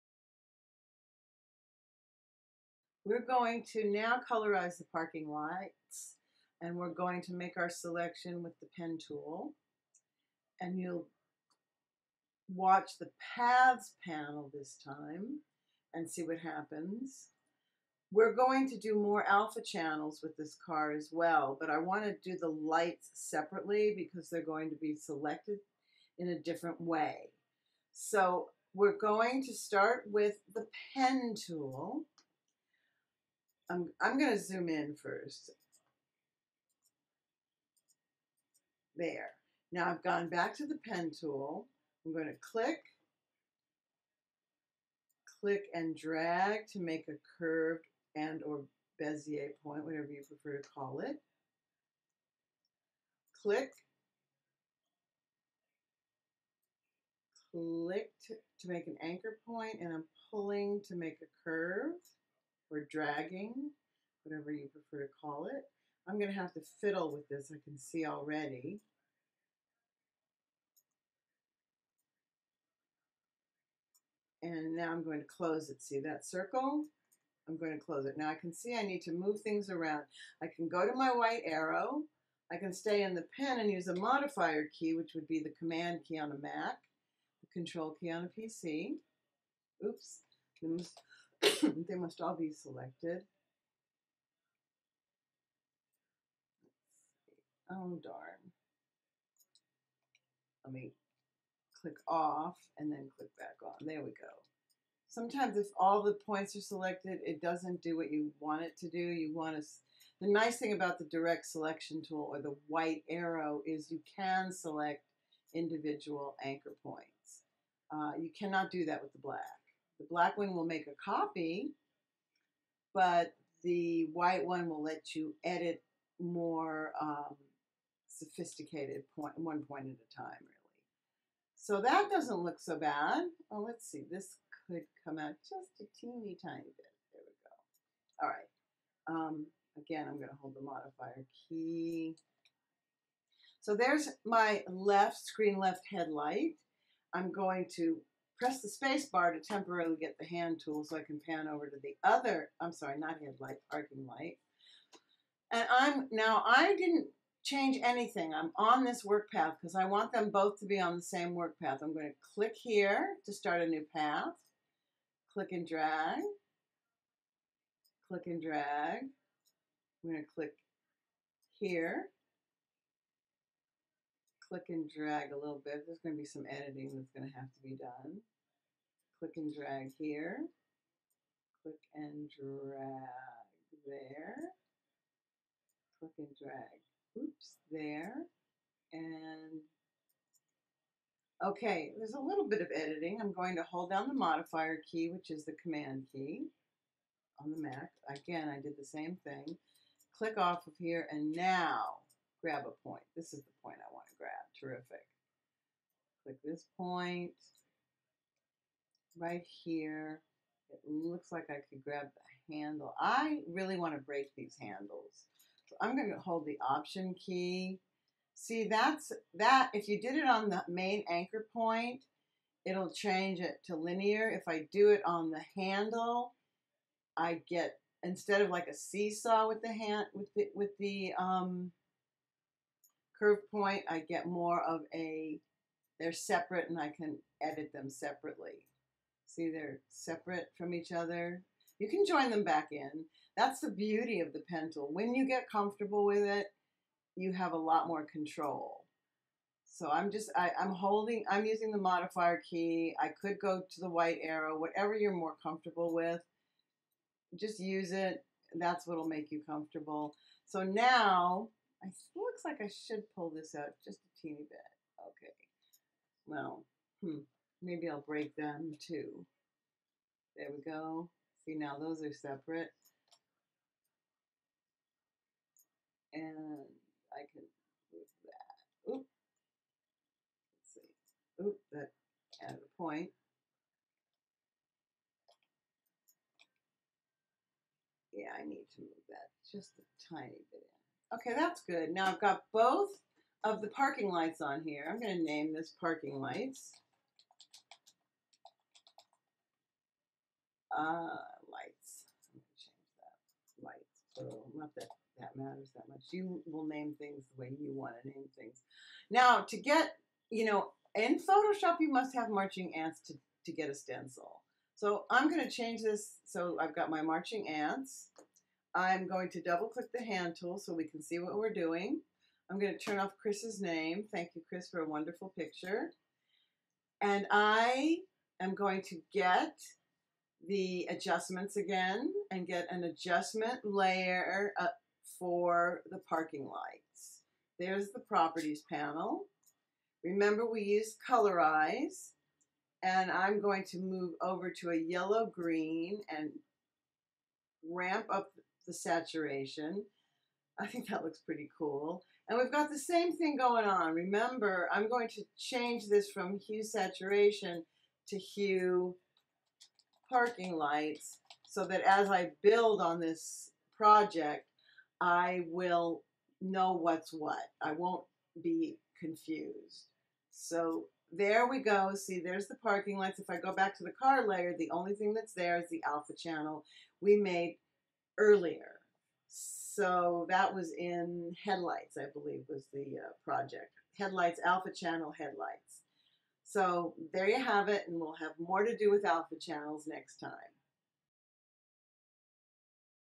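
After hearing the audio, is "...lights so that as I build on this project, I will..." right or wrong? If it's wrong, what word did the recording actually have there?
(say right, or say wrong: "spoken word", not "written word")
right.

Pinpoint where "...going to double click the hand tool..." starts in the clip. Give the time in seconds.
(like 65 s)
319 s.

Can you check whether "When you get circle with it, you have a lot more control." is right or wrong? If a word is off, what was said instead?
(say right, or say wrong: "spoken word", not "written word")
wrong: "comfortable", not "circle".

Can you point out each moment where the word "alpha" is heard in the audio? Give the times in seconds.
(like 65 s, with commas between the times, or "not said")
19 s, 375 s, 384 s, 389 s.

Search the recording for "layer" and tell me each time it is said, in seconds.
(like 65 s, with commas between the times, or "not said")
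333 s, 374 s.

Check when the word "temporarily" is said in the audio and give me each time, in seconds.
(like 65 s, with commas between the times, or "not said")
149 s.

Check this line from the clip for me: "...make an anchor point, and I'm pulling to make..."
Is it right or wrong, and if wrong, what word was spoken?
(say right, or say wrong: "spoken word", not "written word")
right.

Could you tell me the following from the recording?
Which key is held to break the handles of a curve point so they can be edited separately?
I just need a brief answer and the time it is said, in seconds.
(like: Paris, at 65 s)
Option key, at 216 s.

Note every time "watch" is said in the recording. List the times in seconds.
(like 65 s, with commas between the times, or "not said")
12 s.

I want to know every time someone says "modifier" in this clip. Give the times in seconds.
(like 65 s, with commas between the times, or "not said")
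83 s, 140 s, 194 s, 251 s.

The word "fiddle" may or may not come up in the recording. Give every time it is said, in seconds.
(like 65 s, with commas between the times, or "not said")
66 s.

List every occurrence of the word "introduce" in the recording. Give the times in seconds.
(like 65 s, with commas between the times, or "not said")
not said.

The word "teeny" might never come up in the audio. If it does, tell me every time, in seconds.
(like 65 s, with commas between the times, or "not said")
135 s, 264 s.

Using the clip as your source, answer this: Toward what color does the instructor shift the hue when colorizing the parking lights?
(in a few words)
Yellow green.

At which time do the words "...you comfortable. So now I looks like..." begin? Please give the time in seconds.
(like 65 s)
259 s.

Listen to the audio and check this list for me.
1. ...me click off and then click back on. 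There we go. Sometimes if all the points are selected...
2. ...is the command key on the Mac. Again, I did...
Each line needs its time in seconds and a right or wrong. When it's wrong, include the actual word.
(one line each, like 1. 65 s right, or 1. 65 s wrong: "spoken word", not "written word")
1. 100 s right
2. 195 s right.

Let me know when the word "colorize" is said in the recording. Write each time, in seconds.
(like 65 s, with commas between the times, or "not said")
4 s, 341 s.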